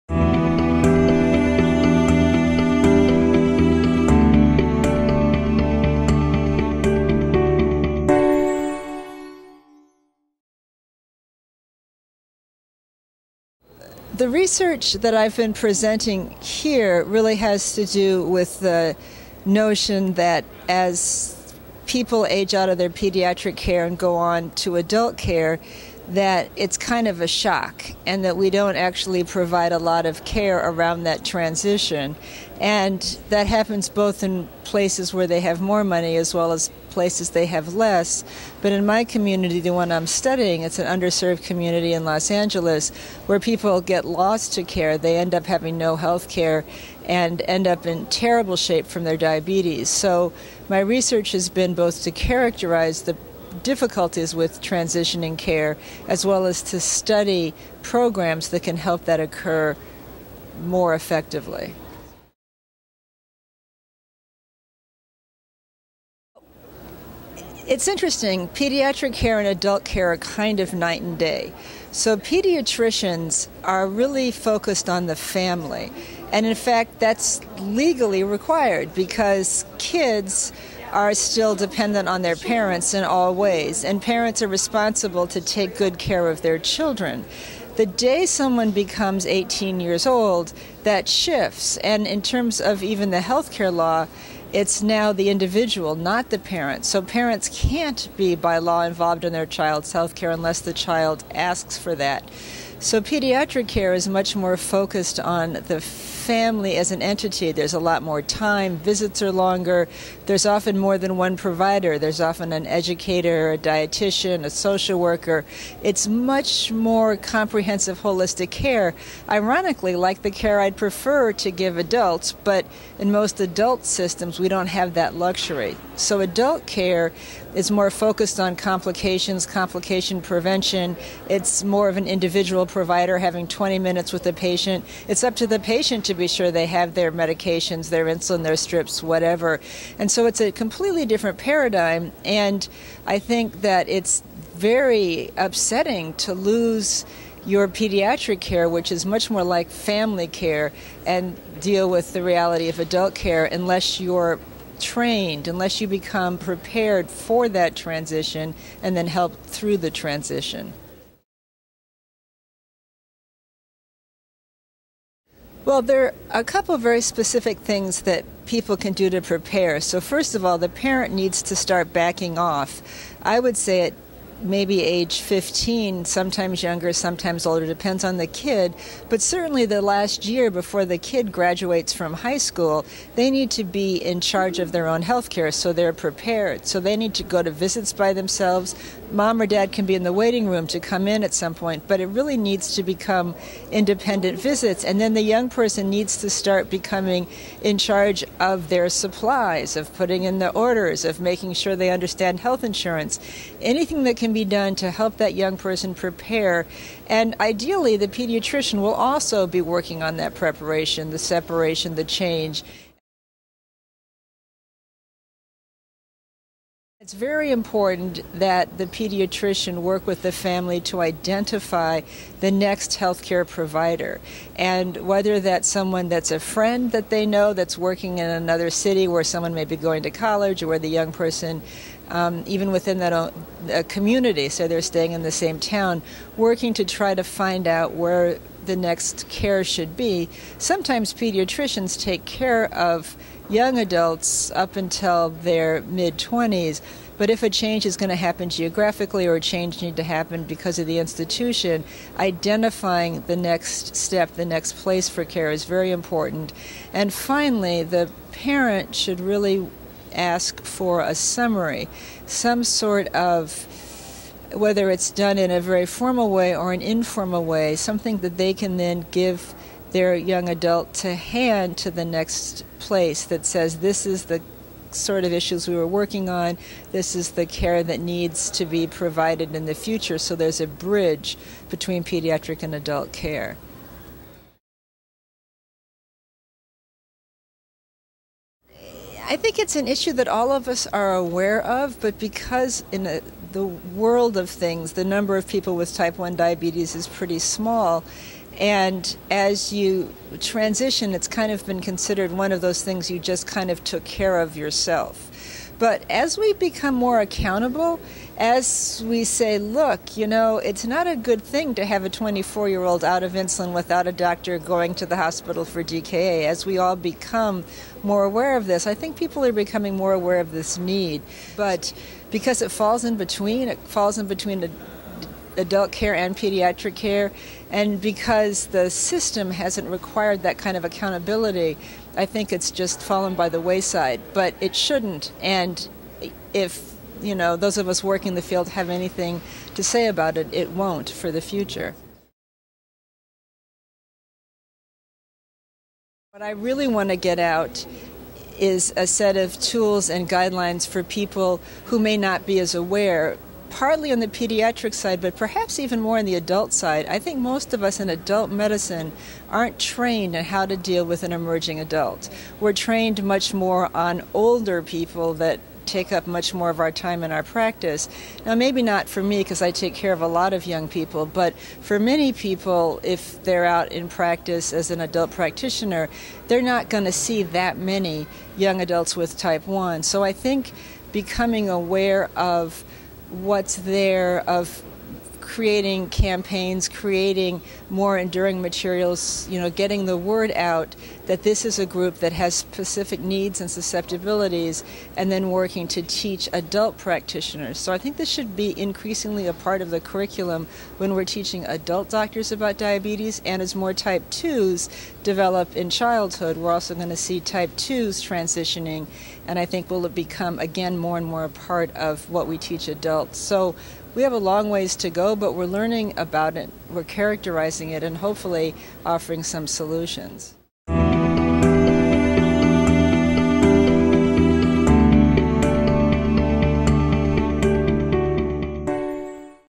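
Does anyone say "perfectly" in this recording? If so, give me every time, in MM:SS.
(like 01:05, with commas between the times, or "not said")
not said.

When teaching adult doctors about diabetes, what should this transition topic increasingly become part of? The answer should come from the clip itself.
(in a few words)
The curriculum.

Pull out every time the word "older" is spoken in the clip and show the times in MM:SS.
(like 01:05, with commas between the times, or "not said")
02:57, 06:04.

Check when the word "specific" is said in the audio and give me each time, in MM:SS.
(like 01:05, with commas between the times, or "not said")
02:47, 06:32.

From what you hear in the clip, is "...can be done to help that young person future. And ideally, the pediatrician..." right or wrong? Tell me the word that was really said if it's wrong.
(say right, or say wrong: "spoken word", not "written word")
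wrong: "prepare", not "future".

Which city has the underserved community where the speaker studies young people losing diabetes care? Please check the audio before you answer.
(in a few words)
Los Angeles.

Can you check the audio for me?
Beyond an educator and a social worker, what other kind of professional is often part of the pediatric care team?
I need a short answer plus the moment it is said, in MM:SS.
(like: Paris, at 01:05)
Dietitian, at 01:53.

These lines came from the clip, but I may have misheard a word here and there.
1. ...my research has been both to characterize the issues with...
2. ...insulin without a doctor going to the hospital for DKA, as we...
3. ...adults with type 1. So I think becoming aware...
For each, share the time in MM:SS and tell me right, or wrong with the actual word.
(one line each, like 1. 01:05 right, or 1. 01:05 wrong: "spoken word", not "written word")
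1. 00:50 wrong: "difficulties", not "issues"
2. 05:13 right
3. 06:18 right.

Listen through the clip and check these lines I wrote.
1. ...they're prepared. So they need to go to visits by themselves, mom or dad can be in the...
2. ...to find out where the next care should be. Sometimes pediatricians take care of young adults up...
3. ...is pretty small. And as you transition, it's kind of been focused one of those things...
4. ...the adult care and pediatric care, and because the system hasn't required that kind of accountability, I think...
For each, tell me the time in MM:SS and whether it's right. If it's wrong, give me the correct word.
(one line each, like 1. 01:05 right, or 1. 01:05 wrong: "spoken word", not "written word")
1. 03:05 right
2. 03:57 right
3. 04:56 wrong: "considered", not "focused"
4. 05:24 right.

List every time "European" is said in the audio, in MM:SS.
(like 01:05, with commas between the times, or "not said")
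not said.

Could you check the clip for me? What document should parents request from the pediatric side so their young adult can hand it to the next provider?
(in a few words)
A summary.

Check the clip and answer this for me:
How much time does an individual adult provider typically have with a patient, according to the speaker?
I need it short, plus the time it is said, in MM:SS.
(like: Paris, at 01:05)
20 minutes, at 02:13.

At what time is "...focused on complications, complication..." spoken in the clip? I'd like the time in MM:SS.
02:07.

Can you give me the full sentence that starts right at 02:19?
And so it's a completely different paradigm.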